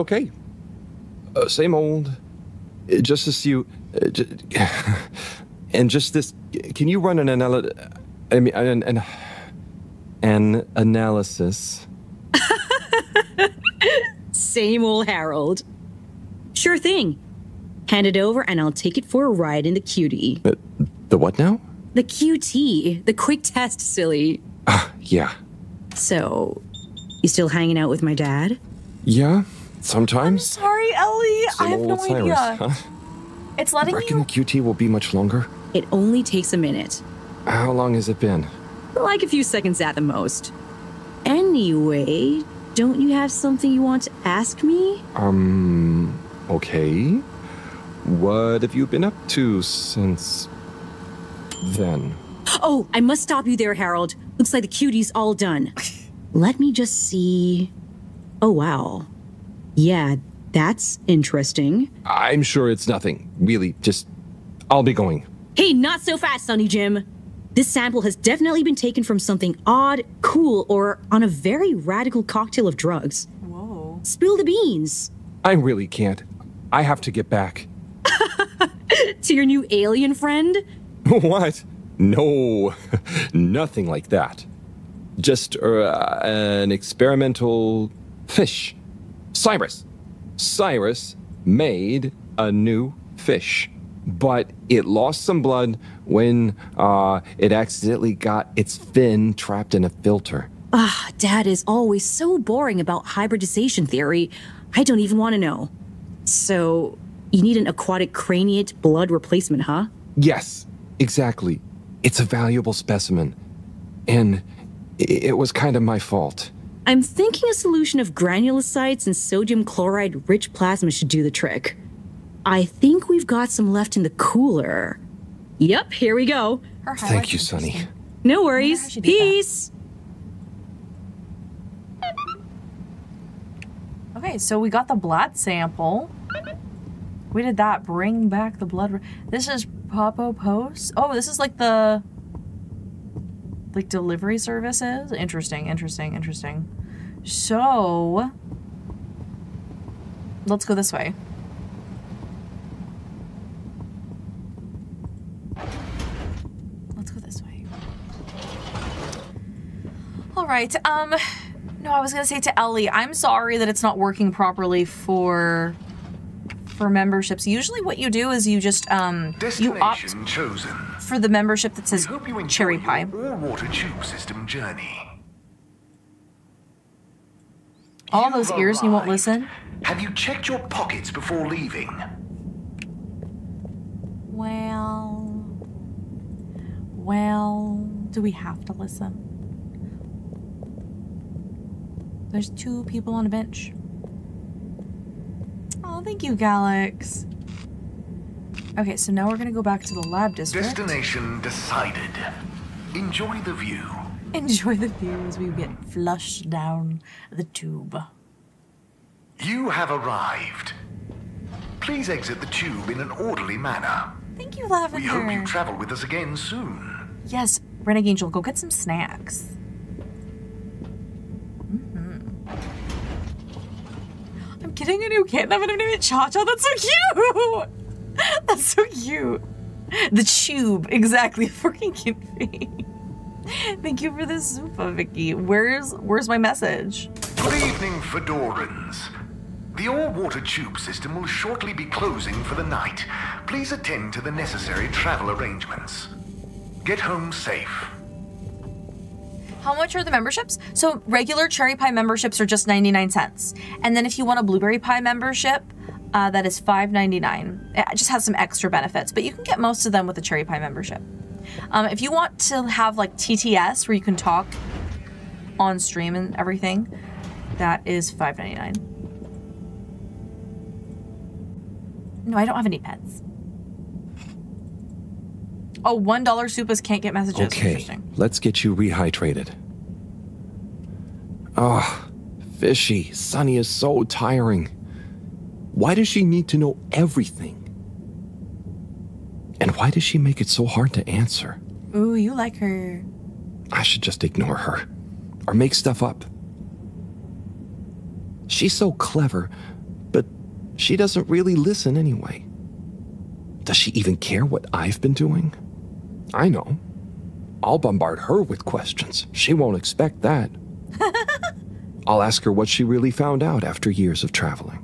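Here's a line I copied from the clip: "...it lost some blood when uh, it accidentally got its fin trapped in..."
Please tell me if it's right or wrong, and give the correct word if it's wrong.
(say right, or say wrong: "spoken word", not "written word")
right.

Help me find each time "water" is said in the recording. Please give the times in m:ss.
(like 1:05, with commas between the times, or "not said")
2:53, 3:59.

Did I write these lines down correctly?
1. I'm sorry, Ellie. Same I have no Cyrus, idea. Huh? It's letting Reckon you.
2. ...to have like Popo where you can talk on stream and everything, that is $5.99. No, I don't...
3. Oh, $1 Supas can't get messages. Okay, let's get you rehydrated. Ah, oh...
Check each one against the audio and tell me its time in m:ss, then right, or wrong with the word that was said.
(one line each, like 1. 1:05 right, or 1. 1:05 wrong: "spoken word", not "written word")
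1. 0:30 right
2. 4:22 wrong: "TTS", not "Popo"
3. 4:35 right.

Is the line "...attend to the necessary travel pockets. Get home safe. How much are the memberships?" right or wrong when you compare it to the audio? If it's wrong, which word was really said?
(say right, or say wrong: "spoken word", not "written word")
wrong: "arrangements", not "pockets".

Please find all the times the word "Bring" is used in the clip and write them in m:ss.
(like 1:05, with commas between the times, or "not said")
2:17.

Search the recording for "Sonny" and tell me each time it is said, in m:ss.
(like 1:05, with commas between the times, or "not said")
1:06, 2:07.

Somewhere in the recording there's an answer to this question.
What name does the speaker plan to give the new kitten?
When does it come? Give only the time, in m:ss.
3:46.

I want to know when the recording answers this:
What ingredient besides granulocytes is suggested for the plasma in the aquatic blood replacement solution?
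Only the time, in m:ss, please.
1:59.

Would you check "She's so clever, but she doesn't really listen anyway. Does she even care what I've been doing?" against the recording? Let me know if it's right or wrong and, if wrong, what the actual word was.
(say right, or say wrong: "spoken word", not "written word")
right.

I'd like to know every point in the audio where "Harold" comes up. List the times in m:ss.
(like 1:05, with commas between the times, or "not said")
0:15, 0:53.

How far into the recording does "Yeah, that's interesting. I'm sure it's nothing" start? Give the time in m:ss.
0:59.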